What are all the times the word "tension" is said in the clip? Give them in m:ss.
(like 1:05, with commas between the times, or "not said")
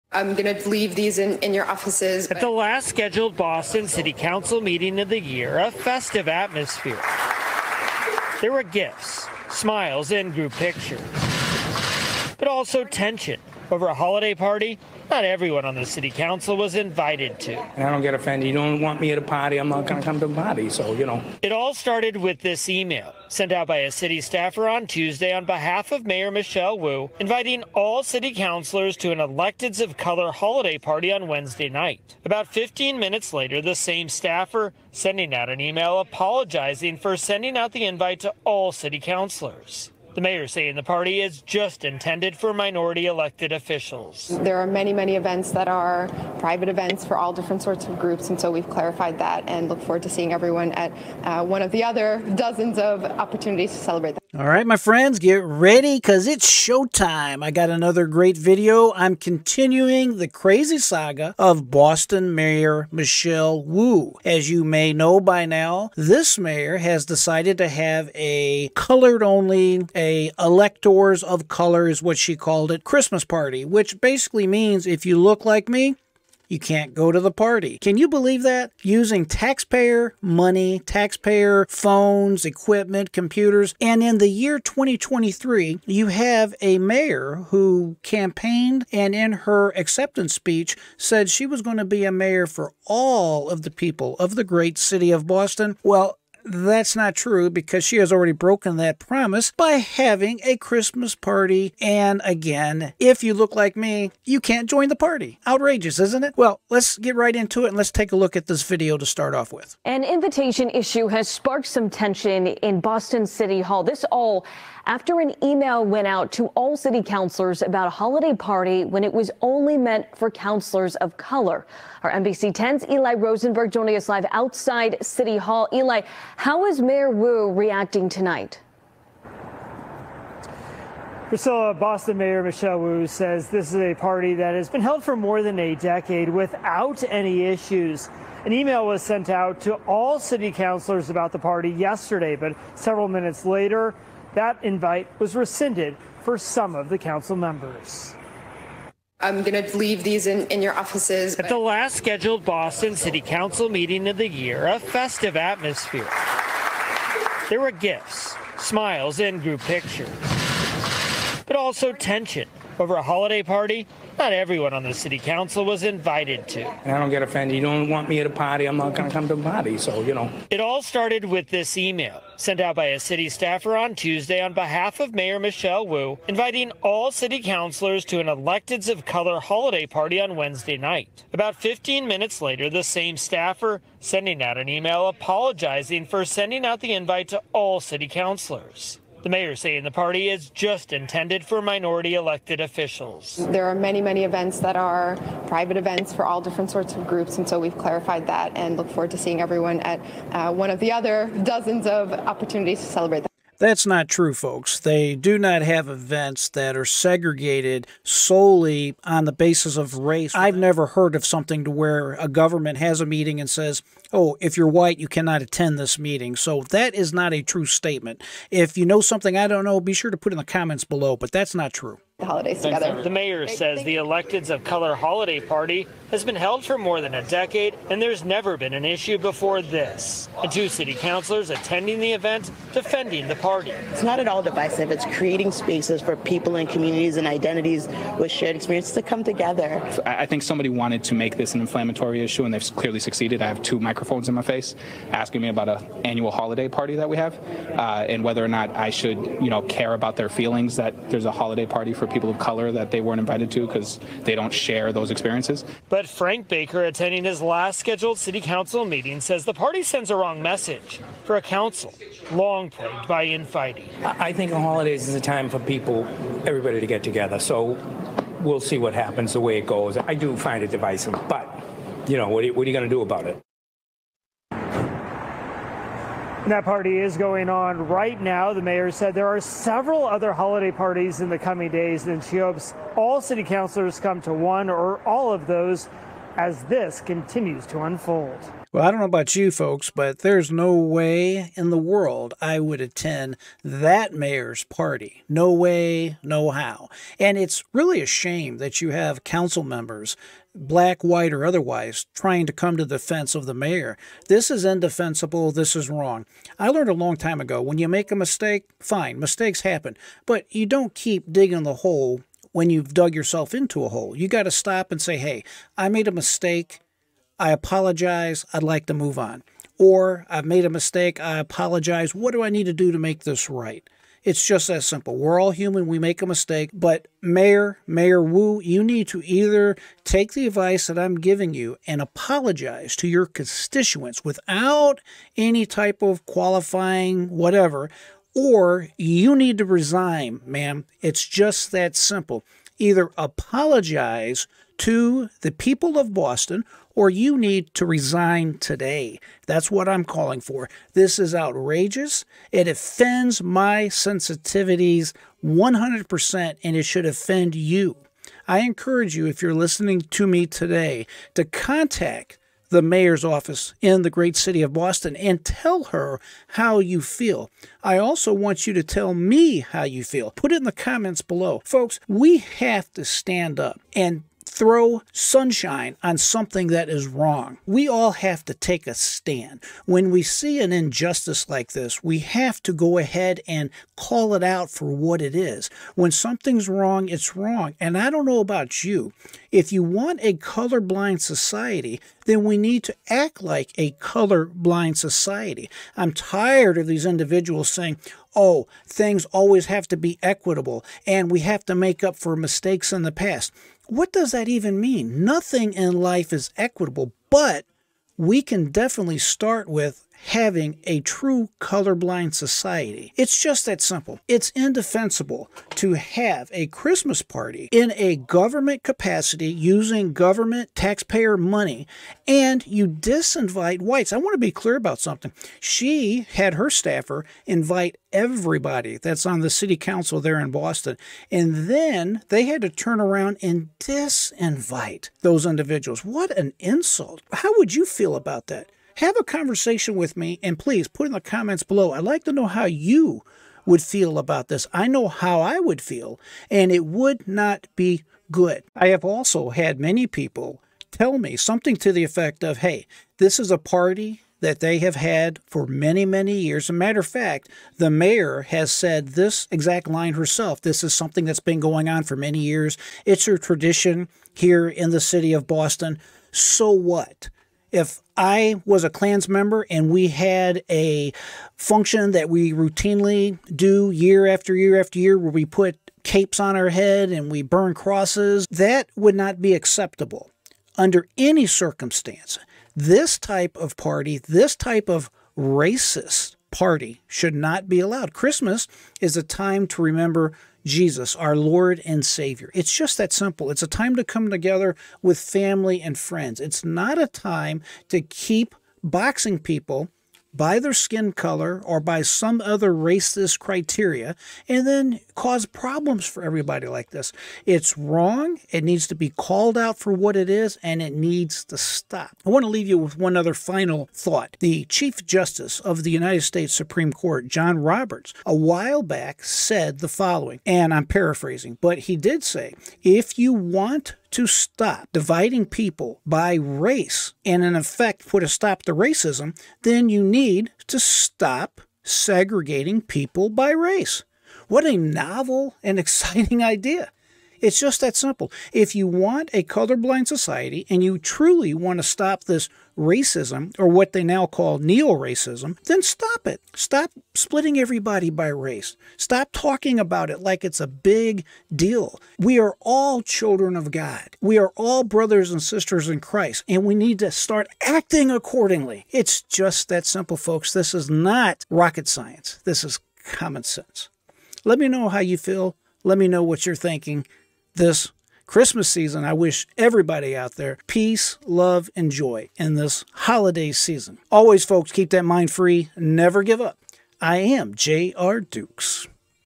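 0:12, 1:51, 2:41.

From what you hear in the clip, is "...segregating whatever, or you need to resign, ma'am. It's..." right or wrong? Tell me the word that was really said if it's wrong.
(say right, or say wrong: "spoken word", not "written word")
wrong: "qualifying", not "segregating".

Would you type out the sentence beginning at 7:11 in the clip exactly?
And then they had to turn around and disinvite those individuals.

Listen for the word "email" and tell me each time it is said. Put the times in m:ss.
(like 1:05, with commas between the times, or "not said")
0:22, 0:35, 1:55, 2:18, 2:51, 3:04.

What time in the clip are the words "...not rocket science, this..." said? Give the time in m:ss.
9:20.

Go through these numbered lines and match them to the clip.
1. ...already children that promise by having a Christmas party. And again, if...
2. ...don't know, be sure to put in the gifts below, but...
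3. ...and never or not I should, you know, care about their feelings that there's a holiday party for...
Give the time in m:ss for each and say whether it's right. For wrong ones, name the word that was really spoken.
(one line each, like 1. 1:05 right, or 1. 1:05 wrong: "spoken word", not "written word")
1. 1:38 wrong: "broken", not "children"
2. 3:39 wrong: "comments", not "gifts"
3. 4:08 wrong: "whether", not "never".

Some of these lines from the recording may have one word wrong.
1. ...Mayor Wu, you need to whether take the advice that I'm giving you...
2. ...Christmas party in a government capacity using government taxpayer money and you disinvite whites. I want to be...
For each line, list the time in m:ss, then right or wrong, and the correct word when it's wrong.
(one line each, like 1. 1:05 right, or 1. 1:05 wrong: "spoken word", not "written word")
1. 5:27 wrong: "either", not "whether"
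2. 6:56 right.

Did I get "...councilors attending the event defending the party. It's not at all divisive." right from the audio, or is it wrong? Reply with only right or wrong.
right.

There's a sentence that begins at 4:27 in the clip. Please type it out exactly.
So we'll see what happens, the way it goes.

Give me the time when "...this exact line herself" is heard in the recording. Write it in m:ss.
7:39.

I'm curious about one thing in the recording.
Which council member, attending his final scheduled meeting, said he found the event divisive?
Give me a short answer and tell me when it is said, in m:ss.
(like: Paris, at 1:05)
Frank Baker, at 4:16.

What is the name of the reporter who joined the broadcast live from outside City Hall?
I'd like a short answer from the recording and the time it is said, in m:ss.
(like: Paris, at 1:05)
Eli Rosenberg, at 2:02.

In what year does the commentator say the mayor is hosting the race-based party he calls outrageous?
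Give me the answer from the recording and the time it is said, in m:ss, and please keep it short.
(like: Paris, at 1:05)
2023, at 1:24.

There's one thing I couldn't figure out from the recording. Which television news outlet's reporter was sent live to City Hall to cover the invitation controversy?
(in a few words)
NBC 10.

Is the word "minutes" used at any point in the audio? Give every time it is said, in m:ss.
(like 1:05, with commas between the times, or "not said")
0:32, 2:23, 3:02.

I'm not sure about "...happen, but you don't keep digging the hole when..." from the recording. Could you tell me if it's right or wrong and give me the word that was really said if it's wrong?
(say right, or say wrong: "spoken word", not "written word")
right.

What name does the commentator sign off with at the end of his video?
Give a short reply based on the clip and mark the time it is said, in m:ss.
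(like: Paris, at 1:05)
J.R. Dukes, at 9:37.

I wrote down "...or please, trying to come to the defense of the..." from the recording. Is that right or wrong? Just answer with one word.
wrong.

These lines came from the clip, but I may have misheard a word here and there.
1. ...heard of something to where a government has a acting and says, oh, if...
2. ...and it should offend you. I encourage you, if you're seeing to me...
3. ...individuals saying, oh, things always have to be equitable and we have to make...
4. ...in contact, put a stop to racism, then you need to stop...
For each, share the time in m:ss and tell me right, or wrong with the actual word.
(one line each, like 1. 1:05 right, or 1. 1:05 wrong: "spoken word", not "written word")
1. 3:30 wrong: "meeting", not "acting"
2. 5:56 wrong: "listening", not "seeing"
3. 6:37 right
4. 8:47 wrong: "effect", not "contact".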